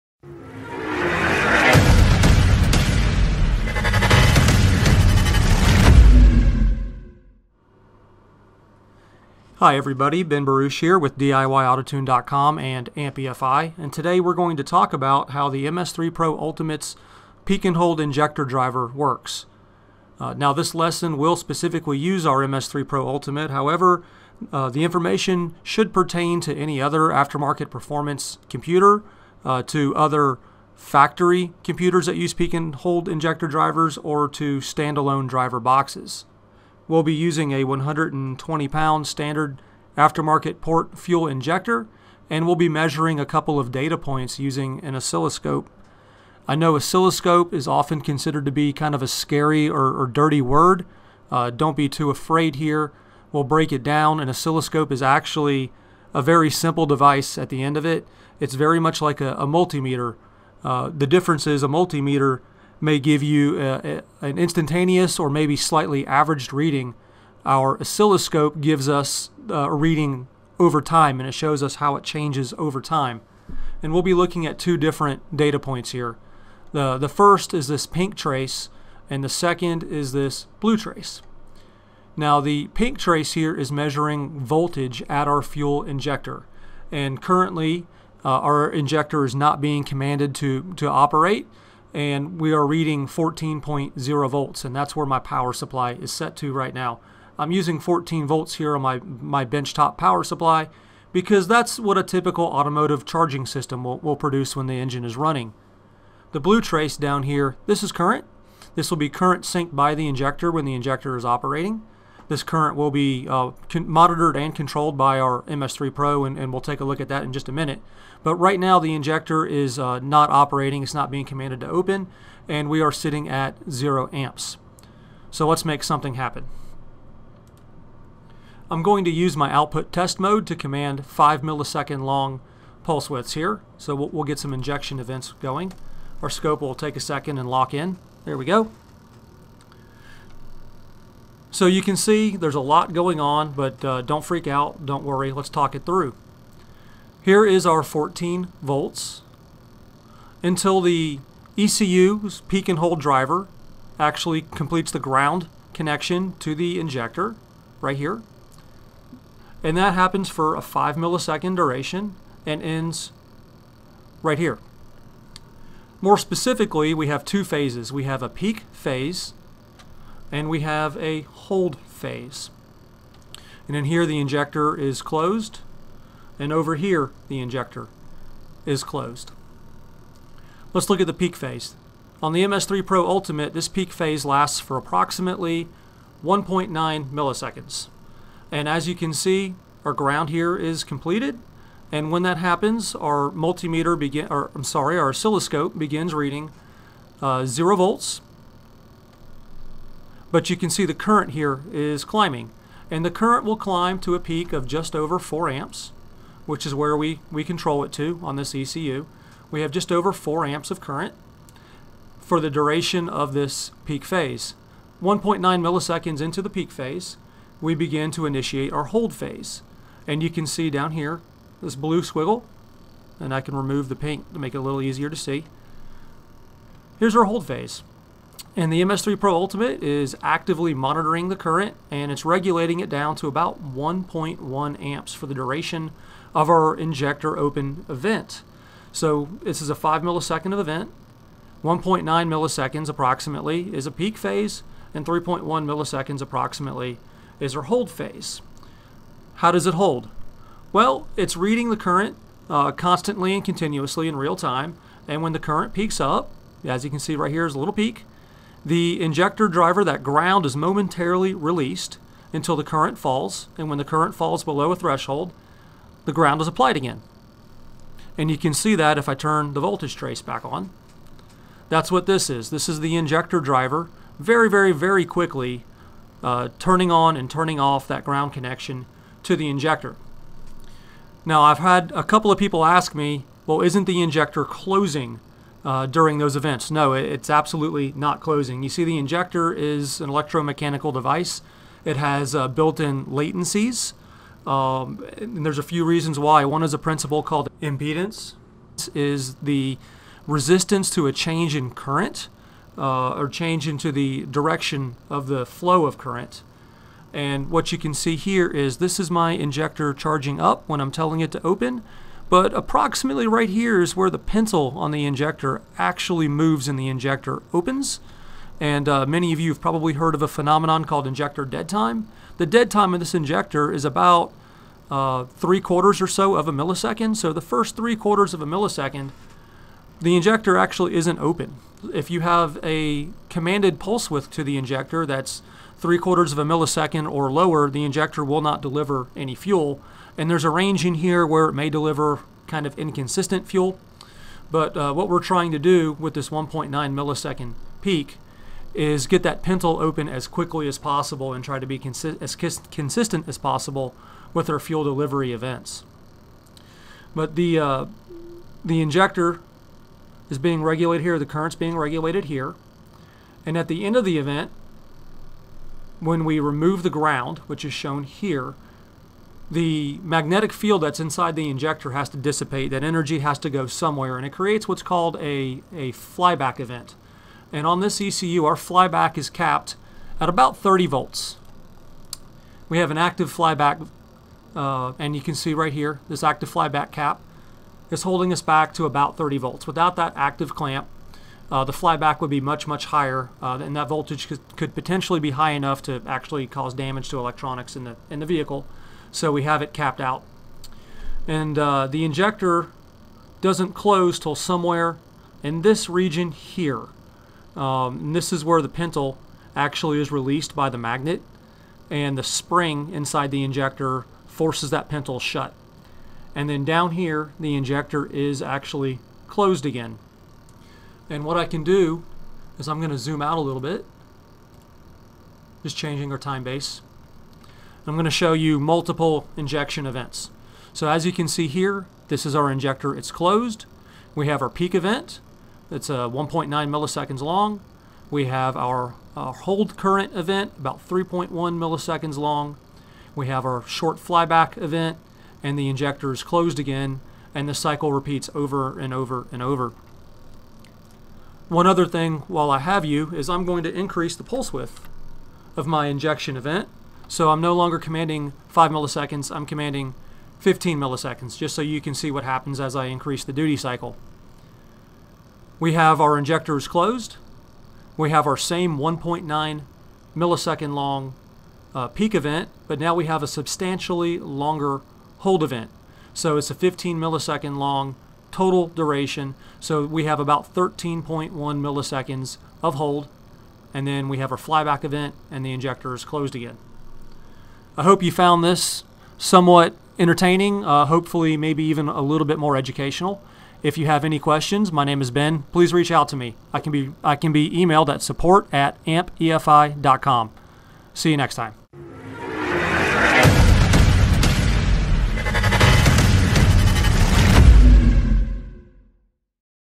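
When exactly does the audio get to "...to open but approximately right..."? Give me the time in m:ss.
5:11.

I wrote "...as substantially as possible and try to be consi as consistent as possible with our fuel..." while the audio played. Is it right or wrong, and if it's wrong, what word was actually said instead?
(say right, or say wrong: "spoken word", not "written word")
wrong: "quickly", not "substantially".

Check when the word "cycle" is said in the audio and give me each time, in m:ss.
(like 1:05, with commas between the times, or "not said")
7:27, 7:43.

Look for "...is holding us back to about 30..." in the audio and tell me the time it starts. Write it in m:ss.
6:27.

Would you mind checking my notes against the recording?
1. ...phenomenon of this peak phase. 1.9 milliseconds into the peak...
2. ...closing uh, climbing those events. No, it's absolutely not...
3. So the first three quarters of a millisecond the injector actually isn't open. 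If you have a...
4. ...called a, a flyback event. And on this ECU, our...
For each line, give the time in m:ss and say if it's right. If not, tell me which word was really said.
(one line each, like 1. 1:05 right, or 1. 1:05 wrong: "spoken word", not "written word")
1. 3:32 wrong: "duration", not "phenomenon"
2. 4:44 wrong: "during", not "climbing"
3. 5:27 right
4. 6:14 right.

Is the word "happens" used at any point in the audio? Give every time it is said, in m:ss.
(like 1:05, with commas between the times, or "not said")
2:06, 2:39, 3:12, 7:42.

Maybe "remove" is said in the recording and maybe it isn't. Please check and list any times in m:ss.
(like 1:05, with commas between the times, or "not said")
3:43, 6:06.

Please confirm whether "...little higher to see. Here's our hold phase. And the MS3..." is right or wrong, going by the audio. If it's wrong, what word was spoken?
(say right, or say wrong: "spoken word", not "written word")
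wrong: "easier", not "higher".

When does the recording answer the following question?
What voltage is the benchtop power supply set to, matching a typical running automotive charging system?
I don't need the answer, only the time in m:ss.
1:33.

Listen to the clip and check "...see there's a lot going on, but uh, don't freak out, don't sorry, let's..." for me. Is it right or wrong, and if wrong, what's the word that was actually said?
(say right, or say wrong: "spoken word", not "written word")
wrong: "worry", not "sorry".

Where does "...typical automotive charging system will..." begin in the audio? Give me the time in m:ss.
1:42.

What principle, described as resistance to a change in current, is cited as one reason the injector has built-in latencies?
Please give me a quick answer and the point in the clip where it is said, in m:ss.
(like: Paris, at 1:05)
impedance, at 4:57.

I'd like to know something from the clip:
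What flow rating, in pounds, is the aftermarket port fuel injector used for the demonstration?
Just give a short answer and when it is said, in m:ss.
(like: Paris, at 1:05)
120 pound, at 0:37.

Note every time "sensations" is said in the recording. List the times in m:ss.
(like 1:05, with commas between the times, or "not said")
not said.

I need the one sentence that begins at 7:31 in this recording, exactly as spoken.
One other thing while I have you is I'm going to increase the pulse width of my injection event.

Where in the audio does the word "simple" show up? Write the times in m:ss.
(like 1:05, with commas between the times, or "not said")
0:56.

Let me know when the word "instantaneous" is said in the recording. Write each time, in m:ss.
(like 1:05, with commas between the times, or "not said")
1:04.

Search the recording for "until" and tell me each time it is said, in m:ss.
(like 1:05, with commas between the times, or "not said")
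2:30, 4:22.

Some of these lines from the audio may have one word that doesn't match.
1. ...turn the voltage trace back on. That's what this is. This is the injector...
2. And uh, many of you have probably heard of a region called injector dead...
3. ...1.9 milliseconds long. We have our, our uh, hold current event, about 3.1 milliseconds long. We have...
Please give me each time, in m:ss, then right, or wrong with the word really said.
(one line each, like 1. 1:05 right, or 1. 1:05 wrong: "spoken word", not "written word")
1. 4:29 right
2. 5:18 wrong: "phenomenon", not "region"
3. 7:16 right.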